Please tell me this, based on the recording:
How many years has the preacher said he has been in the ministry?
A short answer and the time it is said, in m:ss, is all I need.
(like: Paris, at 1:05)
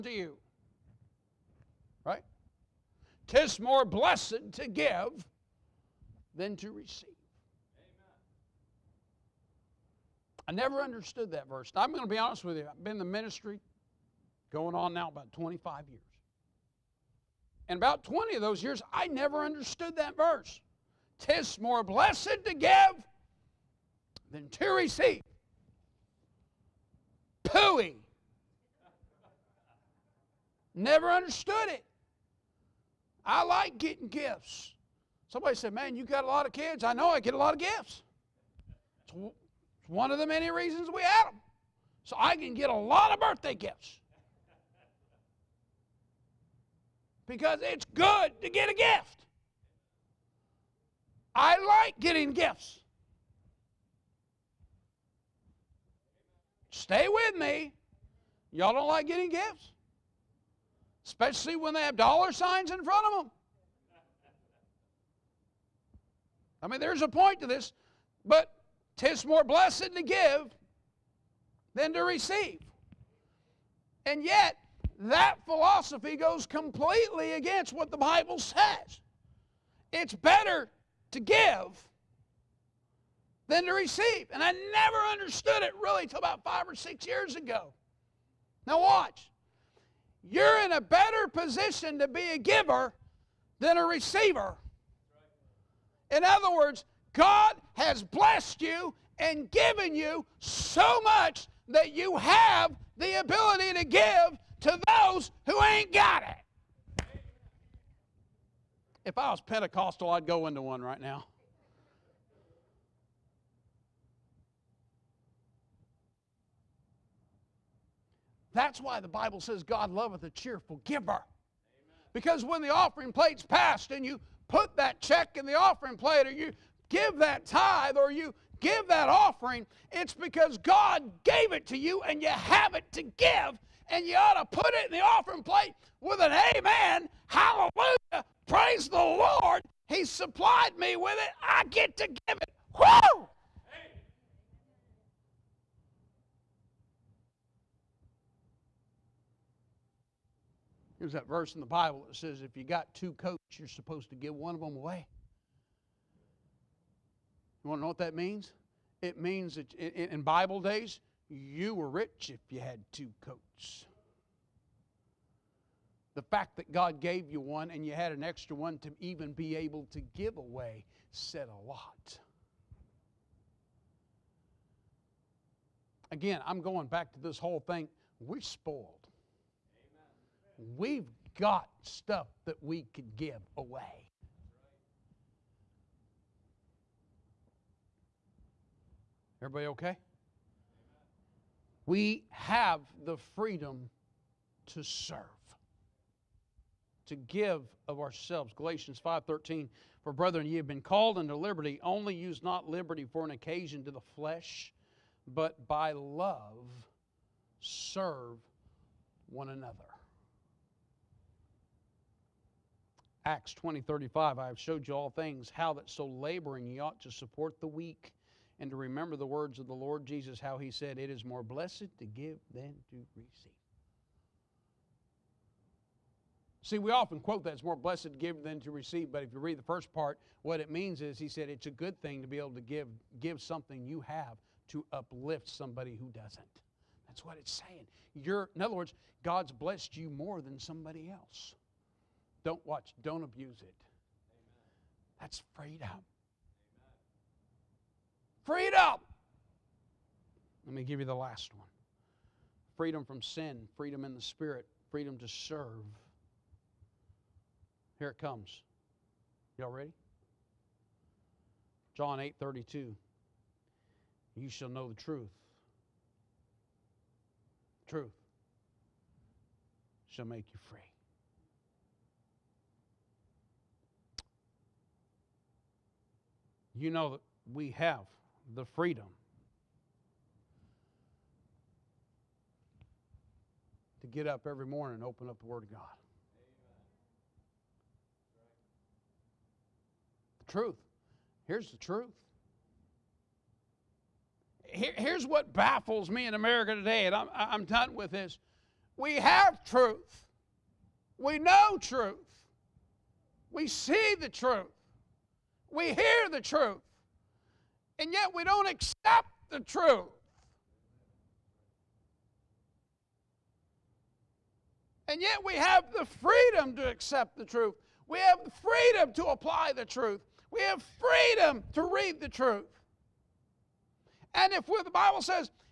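25, at 0:15.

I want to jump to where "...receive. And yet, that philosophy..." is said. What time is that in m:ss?
1:12.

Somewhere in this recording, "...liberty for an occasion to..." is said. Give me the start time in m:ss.
3:22.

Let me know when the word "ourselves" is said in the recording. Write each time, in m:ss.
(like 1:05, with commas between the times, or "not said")
3:18.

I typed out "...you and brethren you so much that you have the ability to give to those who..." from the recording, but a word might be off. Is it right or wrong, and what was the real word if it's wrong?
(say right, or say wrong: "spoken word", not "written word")
wrong: "given", not "brethren".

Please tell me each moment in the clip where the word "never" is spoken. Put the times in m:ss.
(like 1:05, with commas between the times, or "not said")
0:10, 0:19, 0:30, 1:24.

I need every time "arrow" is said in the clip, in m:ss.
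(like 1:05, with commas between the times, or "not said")
not said.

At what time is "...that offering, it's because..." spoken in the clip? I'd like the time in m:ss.
2:08.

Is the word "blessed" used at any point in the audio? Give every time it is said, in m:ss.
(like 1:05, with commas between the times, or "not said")
0:03, 0:21, 1:09, 1:38, 3:41, 3:47, 3:59.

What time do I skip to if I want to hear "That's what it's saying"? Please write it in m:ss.
3:57.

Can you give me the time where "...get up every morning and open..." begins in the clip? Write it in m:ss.
4:44.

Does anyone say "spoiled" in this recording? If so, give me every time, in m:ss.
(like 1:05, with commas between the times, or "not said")
2:58.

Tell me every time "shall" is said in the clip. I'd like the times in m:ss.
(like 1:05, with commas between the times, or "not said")
4:24, 4:30.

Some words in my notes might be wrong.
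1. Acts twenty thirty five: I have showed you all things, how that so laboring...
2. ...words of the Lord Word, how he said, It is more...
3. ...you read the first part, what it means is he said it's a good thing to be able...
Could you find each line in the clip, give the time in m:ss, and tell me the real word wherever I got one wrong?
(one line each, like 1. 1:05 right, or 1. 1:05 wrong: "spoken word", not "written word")
1. 3:33 right
2. 3:39 wrong: "Jesus", not "Word"
3. 3:49 right.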